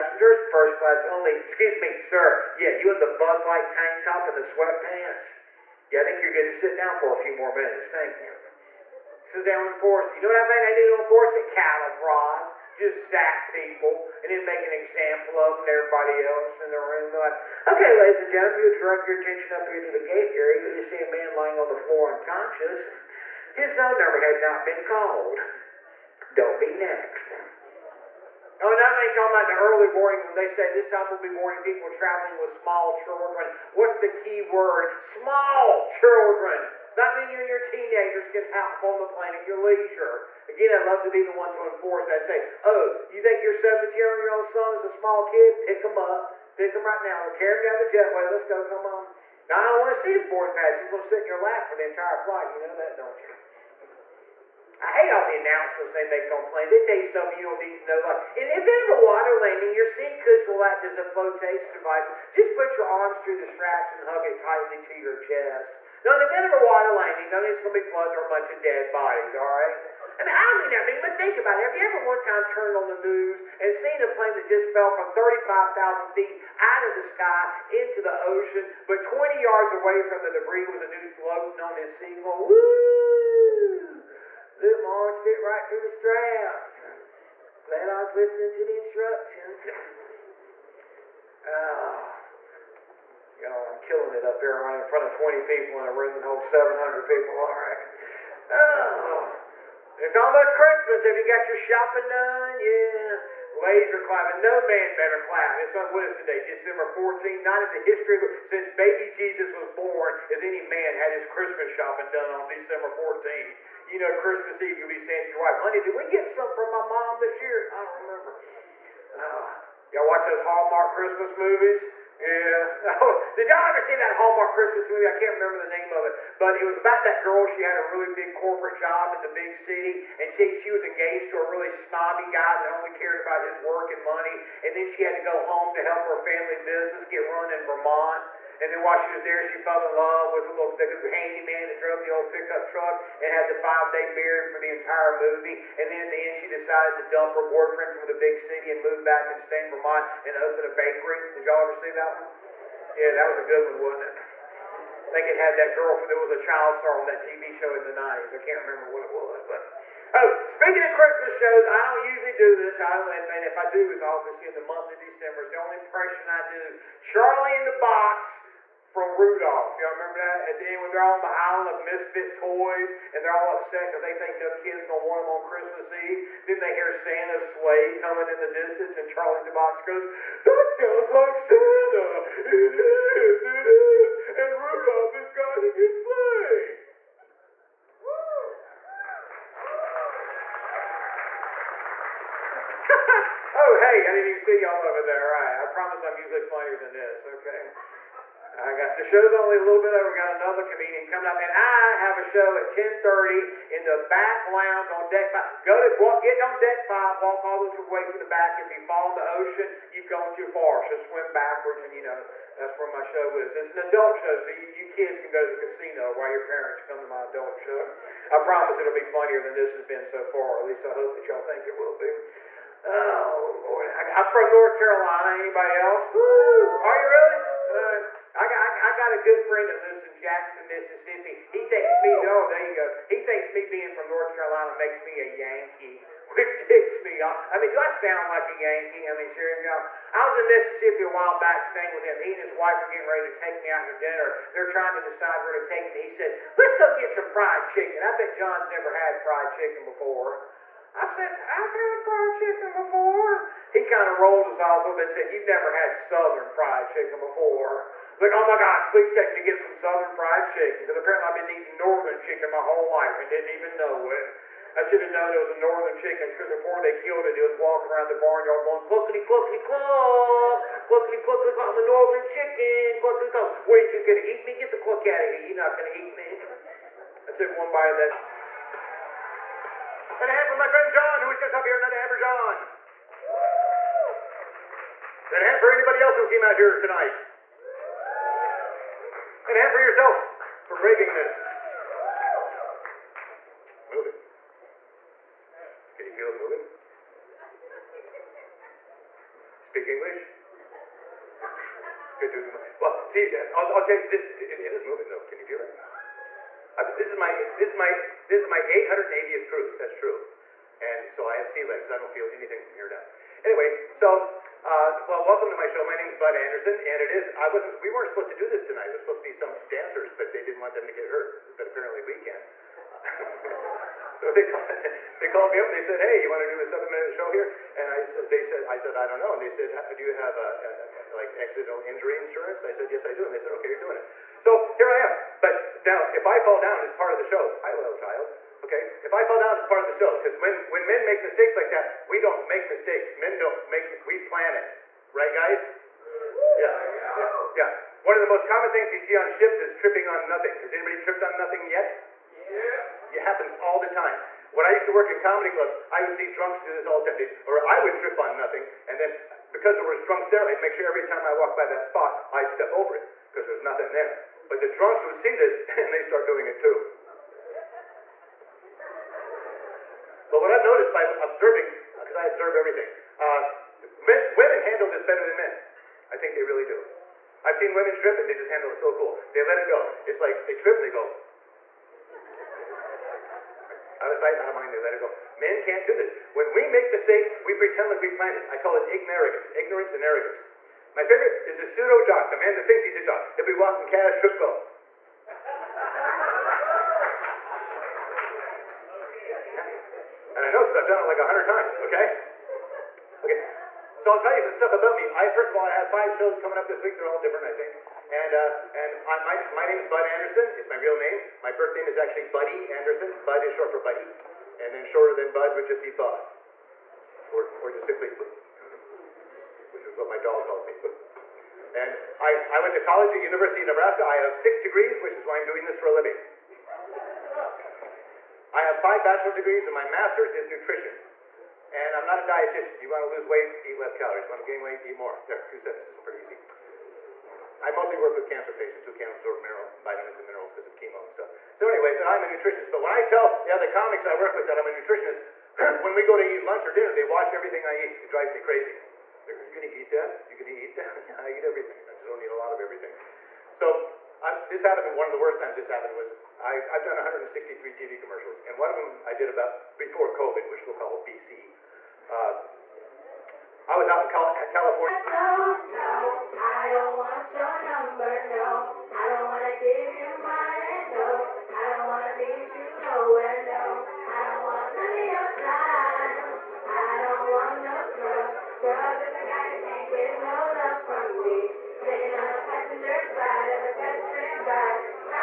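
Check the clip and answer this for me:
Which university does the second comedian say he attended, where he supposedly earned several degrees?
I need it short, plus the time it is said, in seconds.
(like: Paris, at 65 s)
University of Nebraska, at 423 s.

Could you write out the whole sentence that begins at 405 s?
I, first of all, I have five shows coming up this week.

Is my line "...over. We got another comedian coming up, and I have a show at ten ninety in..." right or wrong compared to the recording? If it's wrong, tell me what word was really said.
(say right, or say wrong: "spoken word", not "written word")
wrong: "thirty", not "ninety".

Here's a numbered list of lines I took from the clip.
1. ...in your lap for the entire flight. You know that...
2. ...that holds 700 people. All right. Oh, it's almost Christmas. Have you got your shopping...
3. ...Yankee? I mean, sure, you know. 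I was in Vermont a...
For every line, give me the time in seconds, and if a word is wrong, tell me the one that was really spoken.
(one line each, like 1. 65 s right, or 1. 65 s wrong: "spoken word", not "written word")
1. 51 s right
2. 96 s right
3. 238 s wrong: "Mississippi", not "Vermont".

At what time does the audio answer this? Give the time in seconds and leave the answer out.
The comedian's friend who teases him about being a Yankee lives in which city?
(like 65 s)
230 s.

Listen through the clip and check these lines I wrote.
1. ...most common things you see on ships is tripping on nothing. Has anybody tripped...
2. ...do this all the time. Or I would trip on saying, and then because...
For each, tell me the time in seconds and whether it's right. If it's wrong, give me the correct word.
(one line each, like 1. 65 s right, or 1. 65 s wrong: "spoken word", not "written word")
1. 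348 s right
2. 356 s wrong: "nothing", not "saying".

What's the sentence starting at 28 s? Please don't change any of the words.
Oh, now they talking about the early warning when they say this time we'll be warning people traveling with small children.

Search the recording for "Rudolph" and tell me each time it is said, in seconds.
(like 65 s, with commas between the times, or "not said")
169 s, 184 s.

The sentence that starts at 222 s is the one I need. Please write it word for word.
Oh Lord, I, am from North Carolina.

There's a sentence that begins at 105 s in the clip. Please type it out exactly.
It's on with today, December fourteenth.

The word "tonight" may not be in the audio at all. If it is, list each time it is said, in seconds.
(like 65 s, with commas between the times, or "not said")
286 s, 318 s.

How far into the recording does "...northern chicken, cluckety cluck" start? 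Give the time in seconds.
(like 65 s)
271 s.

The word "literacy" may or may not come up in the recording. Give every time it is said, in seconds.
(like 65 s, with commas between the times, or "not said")
not said.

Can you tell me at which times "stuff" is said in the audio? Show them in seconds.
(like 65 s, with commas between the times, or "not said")
57 s, 404 s, 441 s.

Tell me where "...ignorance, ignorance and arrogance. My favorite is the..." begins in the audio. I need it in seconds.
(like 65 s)
388 s.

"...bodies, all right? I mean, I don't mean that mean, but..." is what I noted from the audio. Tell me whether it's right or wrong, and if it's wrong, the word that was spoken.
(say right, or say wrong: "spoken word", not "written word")
right.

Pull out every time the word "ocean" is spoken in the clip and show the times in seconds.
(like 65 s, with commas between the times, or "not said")
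78 s, 209 s.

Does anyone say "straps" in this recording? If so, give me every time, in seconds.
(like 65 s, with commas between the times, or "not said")
63 s, 85 s.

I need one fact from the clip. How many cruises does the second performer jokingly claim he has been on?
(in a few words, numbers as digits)
880.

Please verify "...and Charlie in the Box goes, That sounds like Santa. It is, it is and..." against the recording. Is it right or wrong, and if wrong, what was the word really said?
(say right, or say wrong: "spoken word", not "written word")
right.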